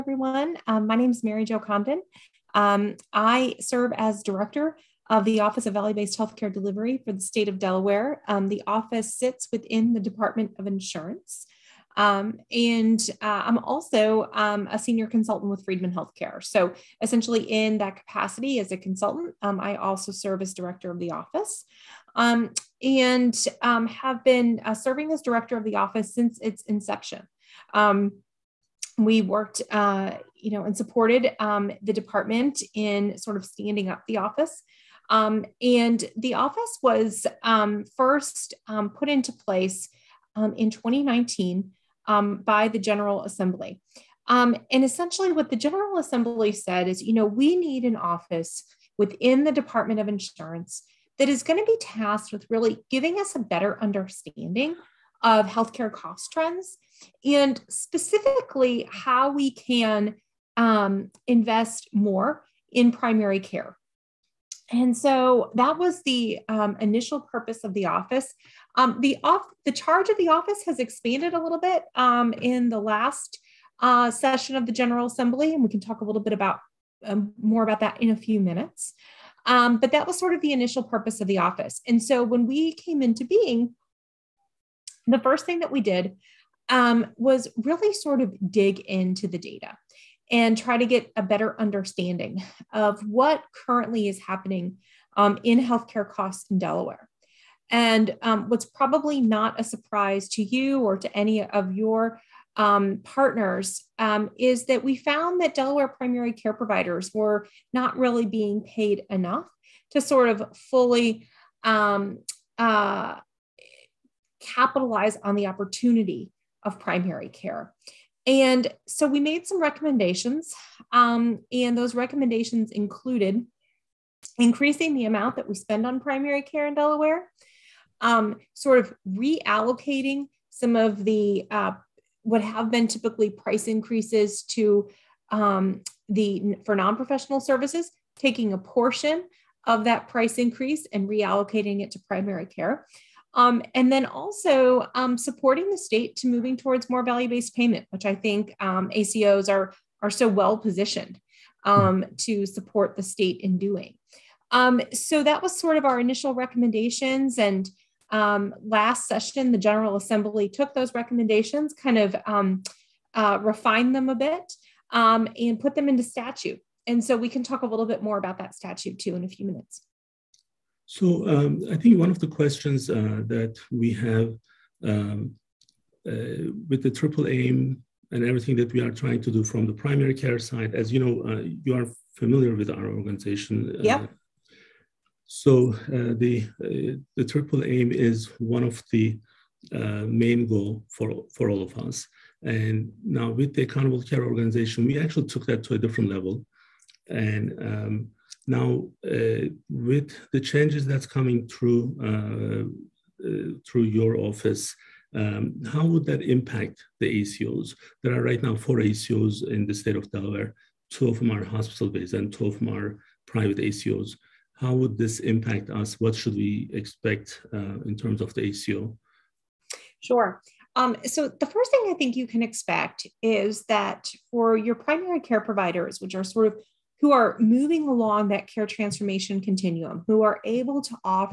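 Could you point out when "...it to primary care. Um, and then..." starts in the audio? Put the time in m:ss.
2:21.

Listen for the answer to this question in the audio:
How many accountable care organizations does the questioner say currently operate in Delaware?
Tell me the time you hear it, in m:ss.
3:28.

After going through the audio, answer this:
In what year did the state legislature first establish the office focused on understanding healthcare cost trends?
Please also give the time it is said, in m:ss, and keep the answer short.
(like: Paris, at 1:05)
2019, at 0:40.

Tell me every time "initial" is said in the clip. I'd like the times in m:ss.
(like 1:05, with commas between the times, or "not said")
1:06, 1:20, 2:35.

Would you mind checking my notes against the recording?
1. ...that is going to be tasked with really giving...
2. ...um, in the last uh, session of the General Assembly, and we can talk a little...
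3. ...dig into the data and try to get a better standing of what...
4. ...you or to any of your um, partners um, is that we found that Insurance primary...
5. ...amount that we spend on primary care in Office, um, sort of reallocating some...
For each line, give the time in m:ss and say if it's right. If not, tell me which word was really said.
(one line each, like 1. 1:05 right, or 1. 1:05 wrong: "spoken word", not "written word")
1. 0:51 right
2. 1:11 right
3. 1:28 wrong: "understanding", not "standing"
4. 1:40 wrong: "Delaware", not "Insurance"
5. 2:05 wrong: "Delaware", not "Office".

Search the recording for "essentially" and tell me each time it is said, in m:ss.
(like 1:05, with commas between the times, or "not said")
0:17, 0:44.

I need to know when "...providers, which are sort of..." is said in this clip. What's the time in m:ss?
3:45.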